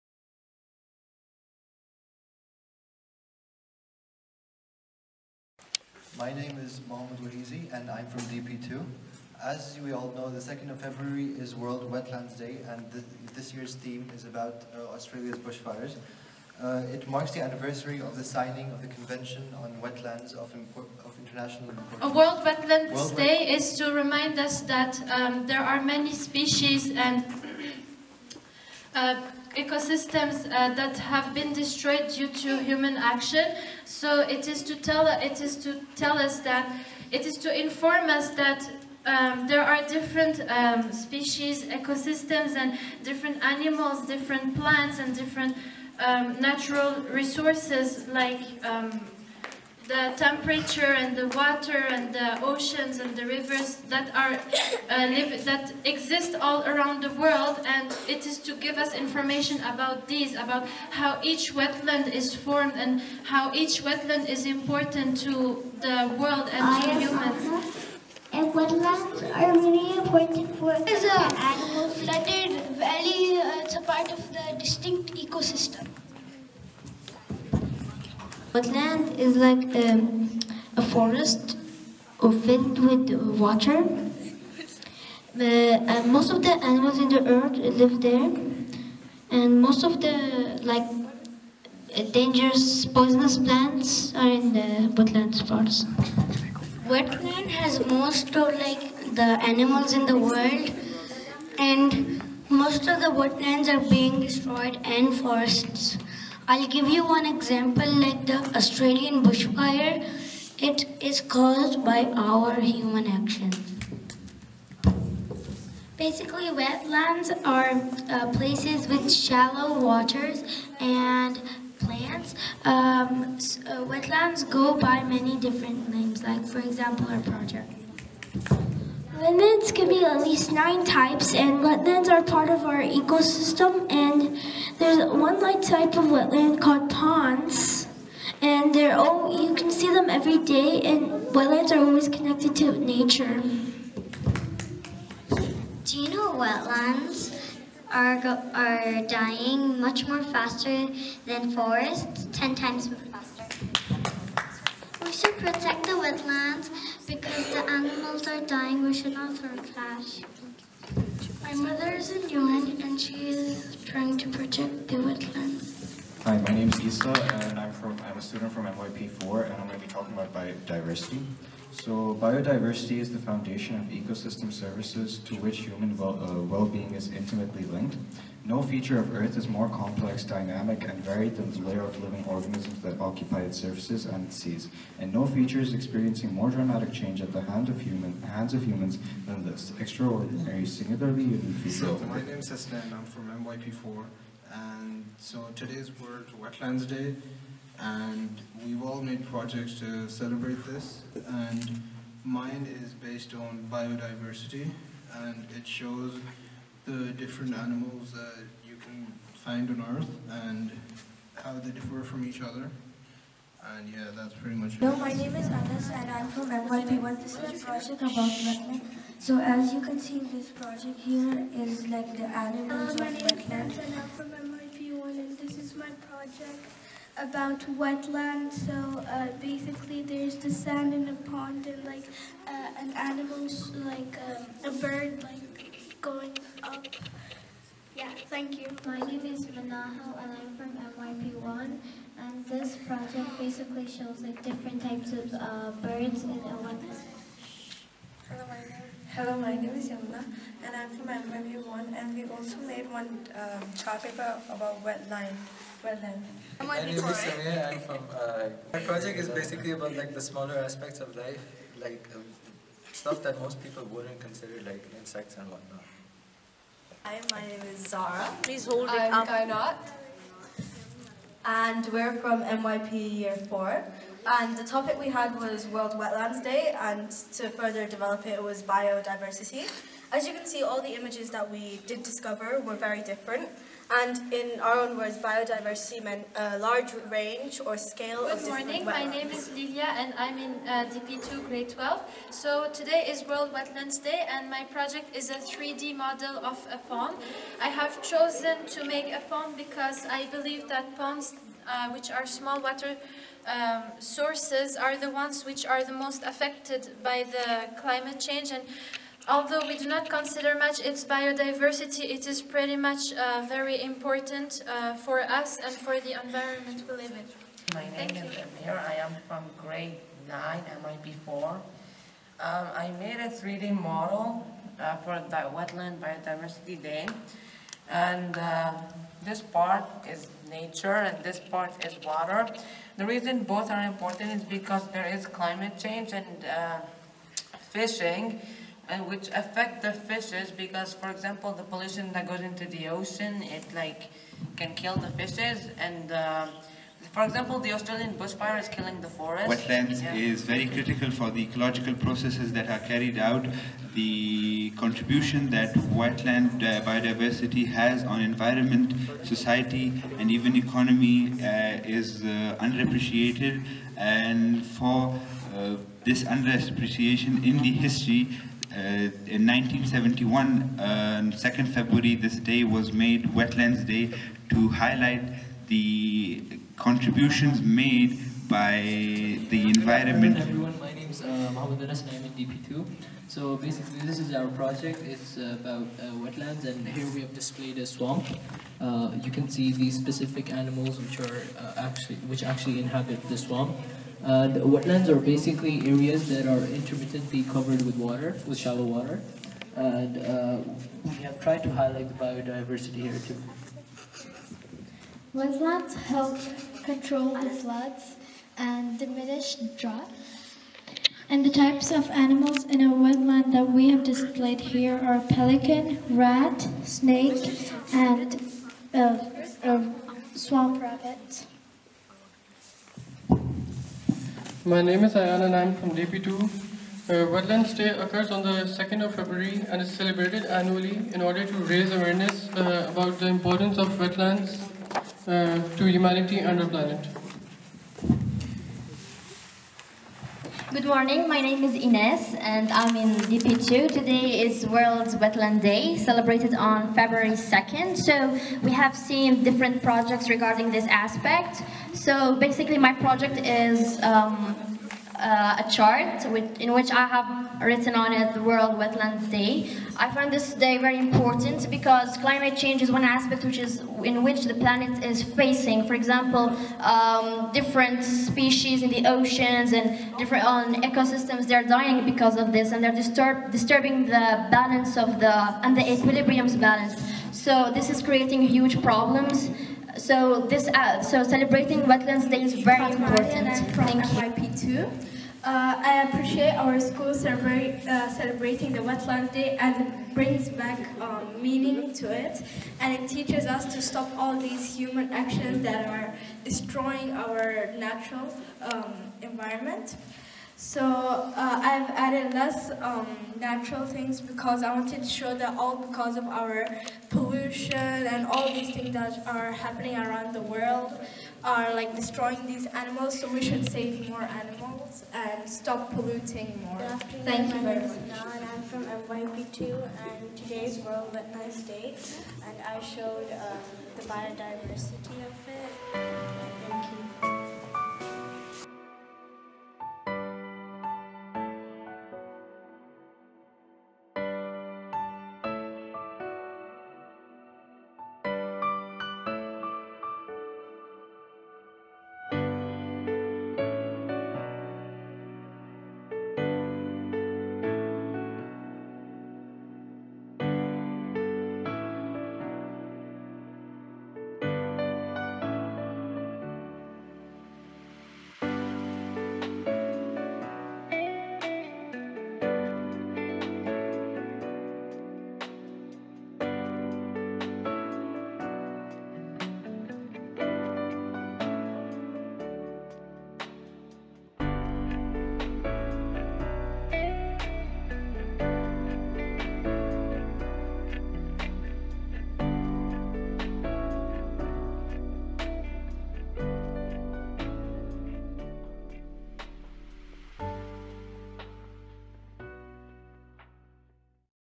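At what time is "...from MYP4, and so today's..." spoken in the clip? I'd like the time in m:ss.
3:13.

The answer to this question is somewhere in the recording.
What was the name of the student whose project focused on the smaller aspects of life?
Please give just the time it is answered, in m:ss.
4:17.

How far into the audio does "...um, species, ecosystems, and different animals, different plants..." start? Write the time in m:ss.
0:40.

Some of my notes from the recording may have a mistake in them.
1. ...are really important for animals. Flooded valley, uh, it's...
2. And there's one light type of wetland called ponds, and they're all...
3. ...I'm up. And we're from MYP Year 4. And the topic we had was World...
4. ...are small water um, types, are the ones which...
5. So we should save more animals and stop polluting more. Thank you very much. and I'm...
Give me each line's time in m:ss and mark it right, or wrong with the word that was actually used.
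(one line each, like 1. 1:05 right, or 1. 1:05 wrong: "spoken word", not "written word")
1. 1:09 right
2. 2:13 right
3. 4:29 right
4. 5:02 wrong: "sources", not "types"
5. 8:33 right.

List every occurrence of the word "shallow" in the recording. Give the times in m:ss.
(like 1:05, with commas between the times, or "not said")
1:59, 6:38.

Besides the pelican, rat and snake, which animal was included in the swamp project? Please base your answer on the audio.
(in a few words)
swamp rabbit.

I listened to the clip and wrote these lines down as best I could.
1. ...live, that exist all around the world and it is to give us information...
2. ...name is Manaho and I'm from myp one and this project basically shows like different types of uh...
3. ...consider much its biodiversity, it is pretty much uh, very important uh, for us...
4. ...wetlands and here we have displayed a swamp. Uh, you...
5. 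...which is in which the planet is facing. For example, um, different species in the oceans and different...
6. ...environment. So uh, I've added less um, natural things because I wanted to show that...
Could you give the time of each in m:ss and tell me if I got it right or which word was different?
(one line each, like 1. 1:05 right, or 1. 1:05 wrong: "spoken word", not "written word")
1. 0:55 right
2. 3:58 right
3. 5:10 right
4. 6:26 right
5. 7:43 right
6. 8:19 right.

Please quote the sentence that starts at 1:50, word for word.
It is caused by our human actions.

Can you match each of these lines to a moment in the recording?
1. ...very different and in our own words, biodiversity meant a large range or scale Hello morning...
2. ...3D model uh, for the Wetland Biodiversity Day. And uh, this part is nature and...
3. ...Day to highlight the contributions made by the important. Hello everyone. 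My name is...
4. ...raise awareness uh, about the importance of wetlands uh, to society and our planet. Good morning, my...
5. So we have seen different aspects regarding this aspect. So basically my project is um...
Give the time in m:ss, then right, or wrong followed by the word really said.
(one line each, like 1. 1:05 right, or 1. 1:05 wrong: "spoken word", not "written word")
1. 4:42 wrong: "Good", not "Hello"
2. 5:23 right
3. 6:13 wrong: "environment", not "important"
4. 7:11 wrong: "humanity", not "society"
5. 7:27 wrong: "projects", not "aspects".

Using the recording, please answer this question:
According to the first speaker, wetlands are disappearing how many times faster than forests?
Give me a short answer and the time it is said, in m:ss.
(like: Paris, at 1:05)
10, at 2:32.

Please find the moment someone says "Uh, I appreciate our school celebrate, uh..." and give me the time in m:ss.
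8:05.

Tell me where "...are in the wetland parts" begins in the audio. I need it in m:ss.
1:34.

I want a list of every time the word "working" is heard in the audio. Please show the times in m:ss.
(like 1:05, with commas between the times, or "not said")
not said.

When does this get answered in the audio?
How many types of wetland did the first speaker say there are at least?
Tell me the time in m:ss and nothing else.
2:10.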